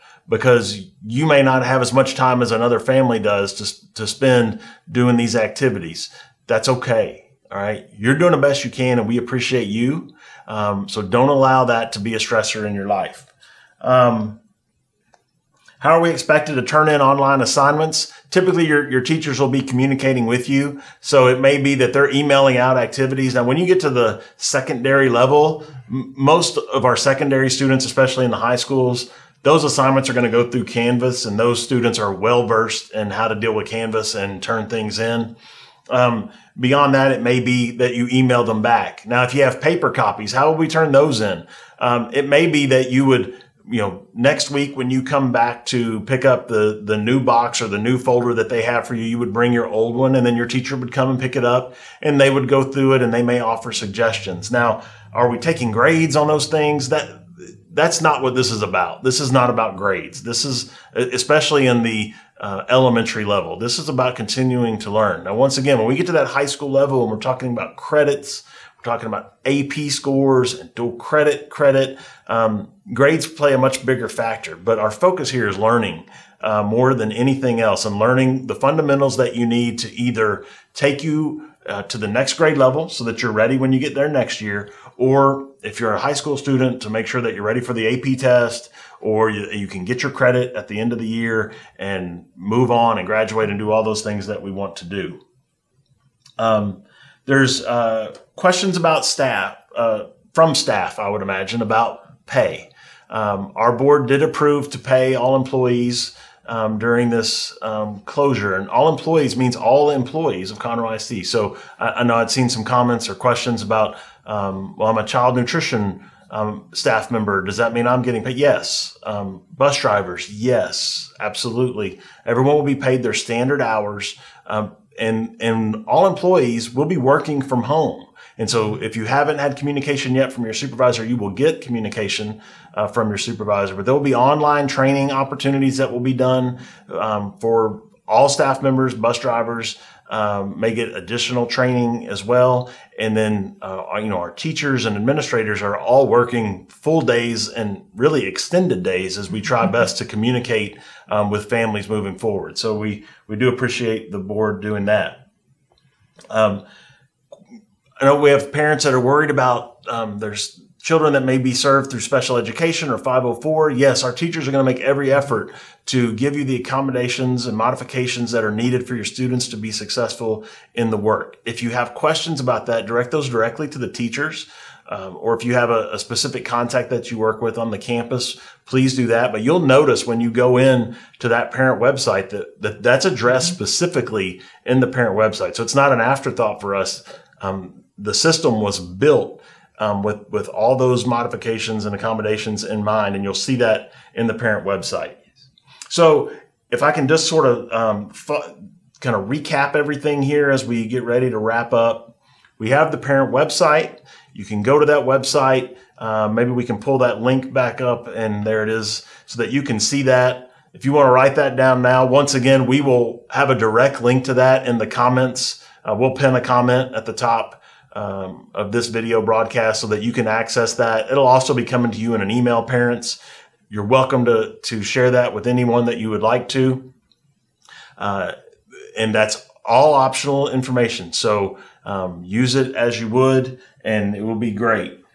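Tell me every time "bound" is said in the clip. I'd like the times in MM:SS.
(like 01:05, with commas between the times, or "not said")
not said.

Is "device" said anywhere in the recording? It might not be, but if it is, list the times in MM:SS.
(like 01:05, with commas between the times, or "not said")
not said.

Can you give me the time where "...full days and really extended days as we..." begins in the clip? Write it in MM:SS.
02:26.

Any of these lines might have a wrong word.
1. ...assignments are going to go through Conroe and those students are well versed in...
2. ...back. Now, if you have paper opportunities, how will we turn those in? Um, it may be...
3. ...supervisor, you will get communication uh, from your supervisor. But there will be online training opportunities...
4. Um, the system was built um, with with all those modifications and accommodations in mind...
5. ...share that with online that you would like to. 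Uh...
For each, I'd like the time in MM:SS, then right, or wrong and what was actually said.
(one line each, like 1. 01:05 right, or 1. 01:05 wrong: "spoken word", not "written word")
1. 00:29 wrong: "Canvas", not "Conroe"
2. 00:38 wrong: "copies", not "opportunities"
3. 02:10 right
4. 03:07 right
5. 03:44 wrong: "anyone", not "online".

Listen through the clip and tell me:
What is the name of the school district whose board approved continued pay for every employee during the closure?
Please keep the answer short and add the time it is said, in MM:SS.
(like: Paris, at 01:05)
Conroe ISD, at 01:50.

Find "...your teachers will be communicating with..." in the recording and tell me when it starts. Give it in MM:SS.
00:18.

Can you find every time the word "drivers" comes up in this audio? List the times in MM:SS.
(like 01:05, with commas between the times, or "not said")
01:59, 02:19.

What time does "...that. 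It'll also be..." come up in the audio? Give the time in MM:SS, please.
03:40.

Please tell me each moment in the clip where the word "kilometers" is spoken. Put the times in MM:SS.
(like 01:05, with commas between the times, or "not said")
not said.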